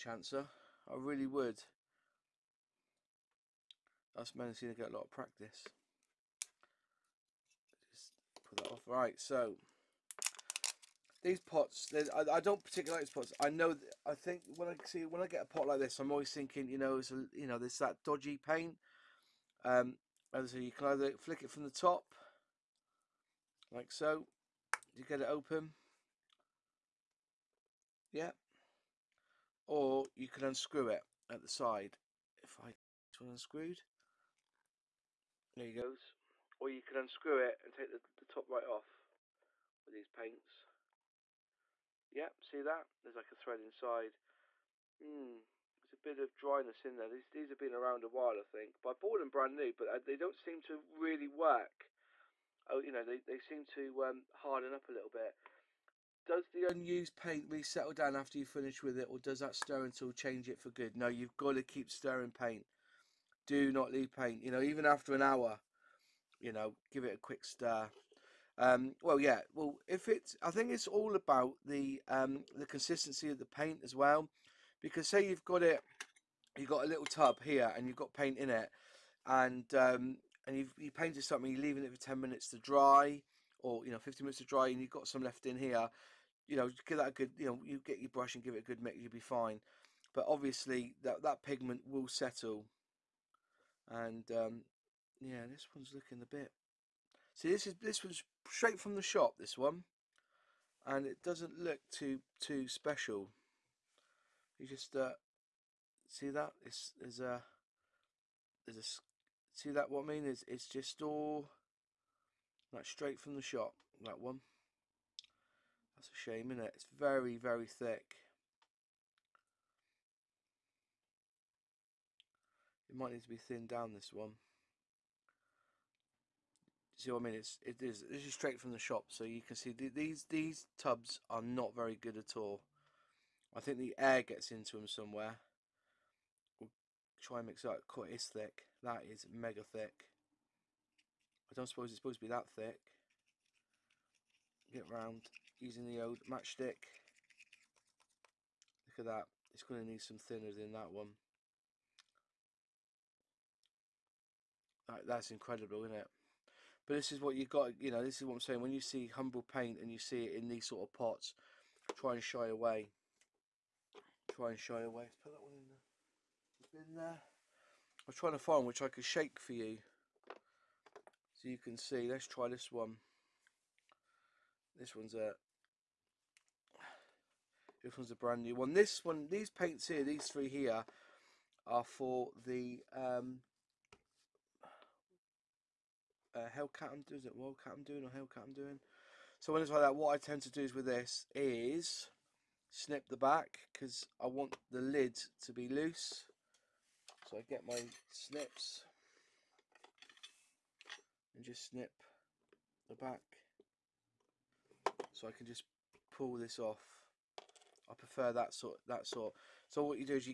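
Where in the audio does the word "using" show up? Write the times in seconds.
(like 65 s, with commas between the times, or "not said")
145 s.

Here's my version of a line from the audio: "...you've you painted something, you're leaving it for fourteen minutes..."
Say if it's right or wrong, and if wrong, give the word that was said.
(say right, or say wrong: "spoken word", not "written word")
wrong: "ten", not "fourteen".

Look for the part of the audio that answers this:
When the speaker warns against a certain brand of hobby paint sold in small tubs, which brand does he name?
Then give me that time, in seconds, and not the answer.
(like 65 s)
159 s.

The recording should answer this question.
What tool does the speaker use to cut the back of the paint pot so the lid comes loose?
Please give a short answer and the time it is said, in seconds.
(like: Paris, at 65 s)
Snips, at 198 s.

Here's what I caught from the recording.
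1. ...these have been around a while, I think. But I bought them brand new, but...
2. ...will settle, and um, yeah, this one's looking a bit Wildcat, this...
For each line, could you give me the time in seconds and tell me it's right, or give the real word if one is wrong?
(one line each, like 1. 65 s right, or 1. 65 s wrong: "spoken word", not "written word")
1. 47 s right
2. 91 s wrong: "See", not "Wildcat".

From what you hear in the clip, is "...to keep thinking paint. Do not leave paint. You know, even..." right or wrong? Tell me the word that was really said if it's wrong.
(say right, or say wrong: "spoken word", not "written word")
wrong: "stirring", not "thinking".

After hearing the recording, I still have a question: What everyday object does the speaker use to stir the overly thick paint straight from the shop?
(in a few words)
Matchstick.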